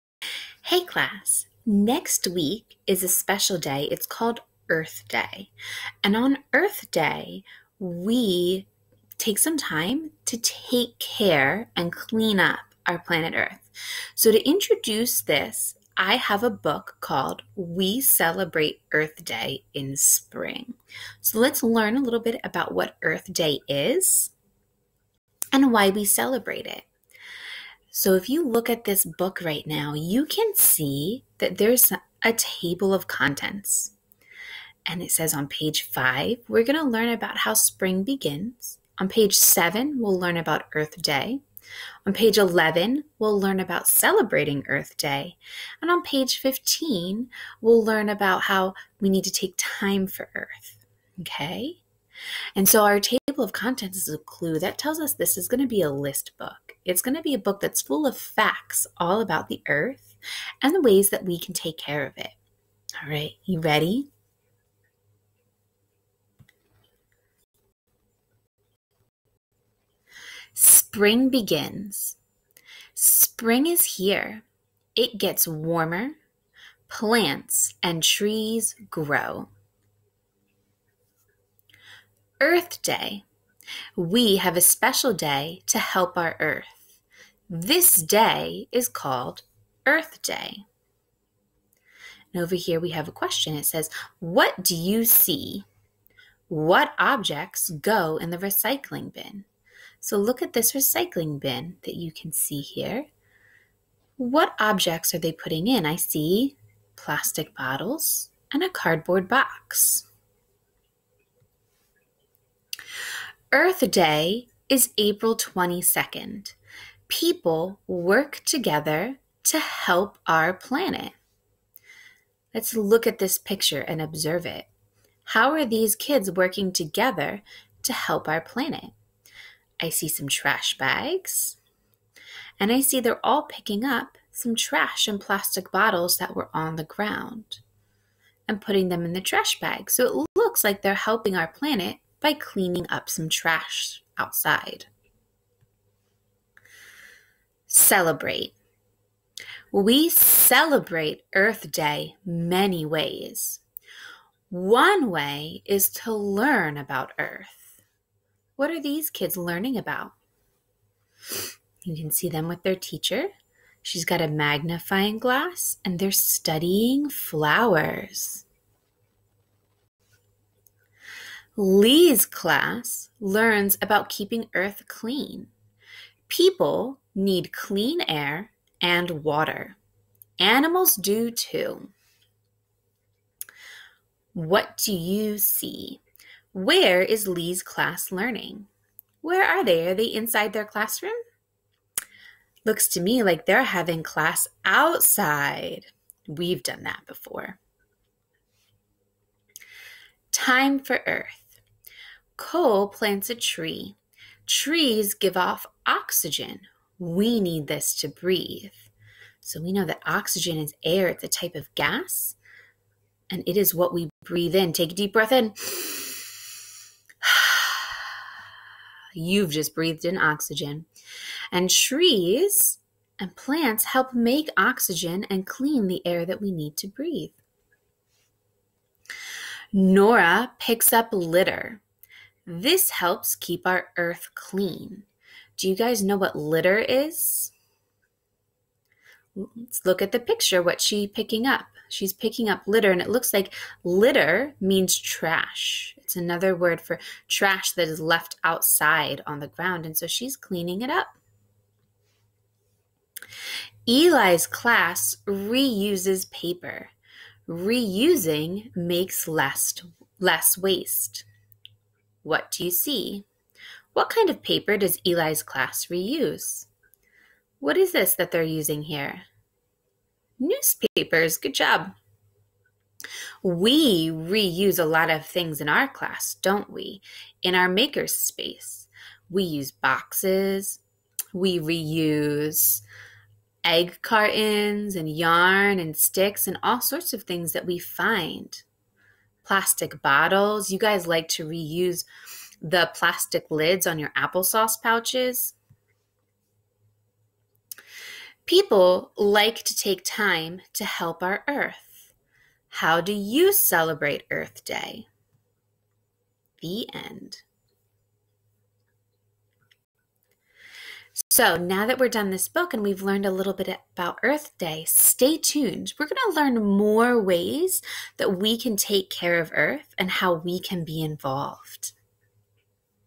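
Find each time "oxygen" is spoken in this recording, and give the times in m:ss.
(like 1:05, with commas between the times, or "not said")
3:25, 3:30, 3:40, 3:44.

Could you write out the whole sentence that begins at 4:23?
What kind of paper does Eli's class reuse?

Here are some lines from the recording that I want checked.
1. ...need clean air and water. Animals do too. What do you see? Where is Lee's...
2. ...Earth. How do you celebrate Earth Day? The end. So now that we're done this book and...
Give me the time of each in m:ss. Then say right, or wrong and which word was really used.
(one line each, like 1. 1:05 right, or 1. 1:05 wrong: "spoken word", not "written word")
1. 2:57 right
2. 5:01 right.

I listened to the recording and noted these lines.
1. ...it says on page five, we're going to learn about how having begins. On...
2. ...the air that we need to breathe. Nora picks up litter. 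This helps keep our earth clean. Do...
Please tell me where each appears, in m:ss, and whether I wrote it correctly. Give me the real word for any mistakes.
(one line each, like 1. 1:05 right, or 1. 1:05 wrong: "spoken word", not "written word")
1. 0:35 wrong: "spring", not "having"
2. 3:45 right.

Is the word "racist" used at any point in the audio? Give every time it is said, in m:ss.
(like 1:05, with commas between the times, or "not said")
not said.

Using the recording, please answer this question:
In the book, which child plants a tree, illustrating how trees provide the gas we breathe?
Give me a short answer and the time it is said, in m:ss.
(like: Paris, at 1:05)
Cole, at 3:22.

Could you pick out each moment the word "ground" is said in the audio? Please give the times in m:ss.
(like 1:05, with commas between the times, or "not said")
2:16, 4:09.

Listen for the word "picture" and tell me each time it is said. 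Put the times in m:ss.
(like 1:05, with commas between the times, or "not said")
2:03, 4:00.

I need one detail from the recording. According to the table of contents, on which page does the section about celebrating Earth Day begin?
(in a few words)
11.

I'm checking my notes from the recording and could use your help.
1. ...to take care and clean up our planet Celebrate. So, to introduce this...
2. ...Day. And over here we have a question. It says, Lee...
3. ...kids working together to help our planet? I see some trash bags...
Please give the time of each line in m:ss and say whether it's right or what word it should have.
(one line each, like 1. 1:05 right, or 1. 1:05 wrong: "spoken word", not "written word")
1. 0:10 wrong: "Earth", not "Celebrate"
2. 1:30 wrong: "What", not "Lee"
3. 2:05 right.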